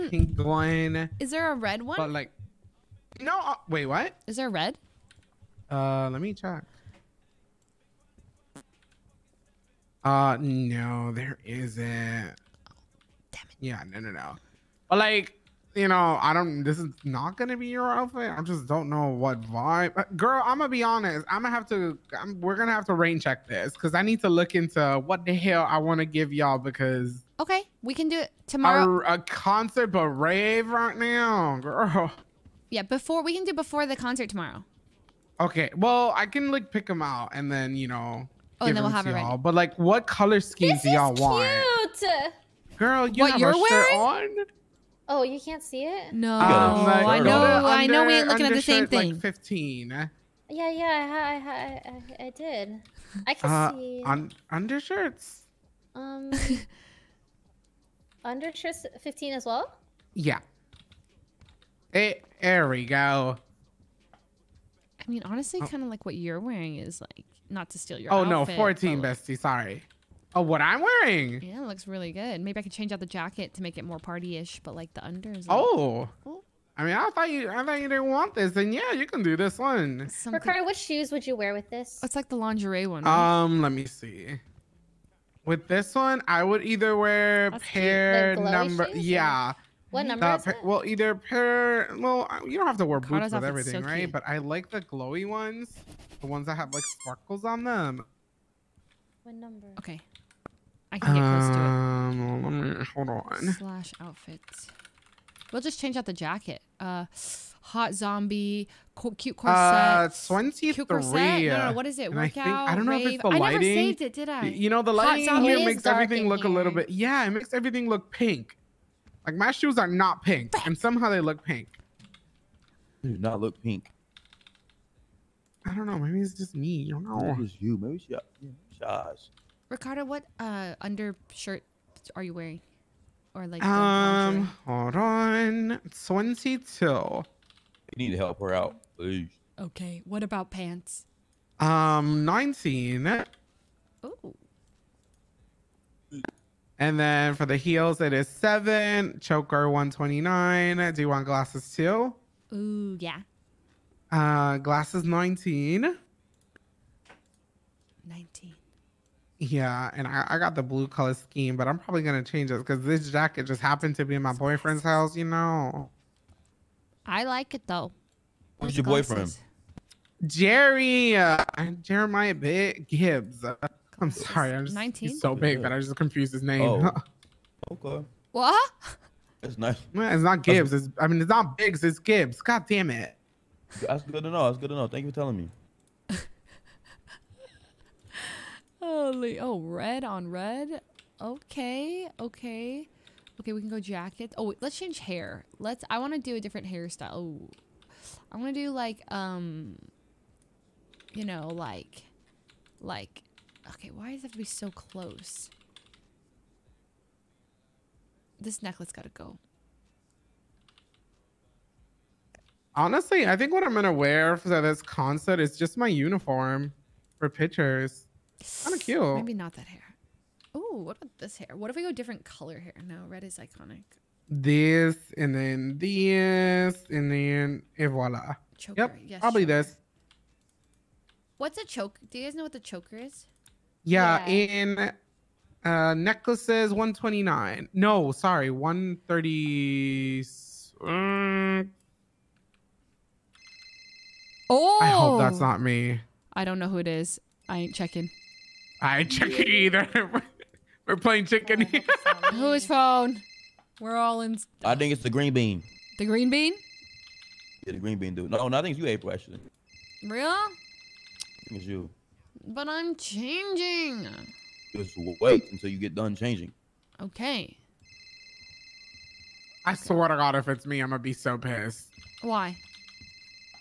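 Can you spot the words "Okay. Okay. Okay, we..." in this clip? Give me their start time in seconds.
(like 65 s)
191 s.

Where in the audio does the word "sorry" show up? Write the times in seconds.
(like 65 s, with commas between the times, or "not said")
69 s, 174 s, 238 s.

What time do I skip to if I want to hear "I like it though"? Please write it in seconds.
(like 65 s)
167 s.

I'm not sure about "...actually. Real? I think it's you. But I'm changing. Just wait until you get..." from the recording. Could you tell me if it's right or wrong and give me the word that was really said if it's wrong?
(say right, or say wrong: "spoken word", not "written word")
right.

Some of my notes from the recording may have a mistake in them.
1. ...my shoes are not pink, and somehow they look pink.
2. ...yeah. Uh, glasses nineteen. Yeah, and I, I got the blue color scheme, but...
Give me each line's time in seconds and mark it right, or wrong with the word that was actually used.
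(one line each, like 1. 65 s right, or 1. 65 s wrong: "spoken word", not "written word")
1. 119 s right
2. 152 s right.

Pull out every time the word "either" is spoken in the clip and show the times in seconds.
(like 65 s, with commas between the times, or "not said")
86 s, 90 s, 249 s.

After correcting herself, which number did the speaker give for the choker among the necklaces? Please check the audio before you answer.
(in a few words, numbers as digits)
130.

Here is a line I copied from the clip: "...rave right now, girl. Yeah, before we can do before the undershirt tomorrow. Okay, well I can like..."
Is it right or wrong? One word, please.
wrong.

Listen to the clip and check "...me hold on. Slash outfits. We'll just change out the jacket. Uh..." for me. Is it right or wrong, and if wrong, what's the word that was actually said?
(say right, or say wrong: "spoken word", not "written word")
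right.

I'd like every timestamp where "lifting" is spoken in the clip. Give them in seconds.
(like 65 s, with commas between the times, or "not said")
not said.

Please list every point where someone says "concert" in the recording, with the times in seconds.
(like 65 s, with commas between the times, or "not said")
29 s, 33 s, 214 s.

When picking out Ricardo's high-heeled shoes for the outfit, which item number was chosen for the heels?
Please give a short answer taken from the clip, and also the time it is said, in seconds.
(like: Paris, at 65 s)
7, at 148 s.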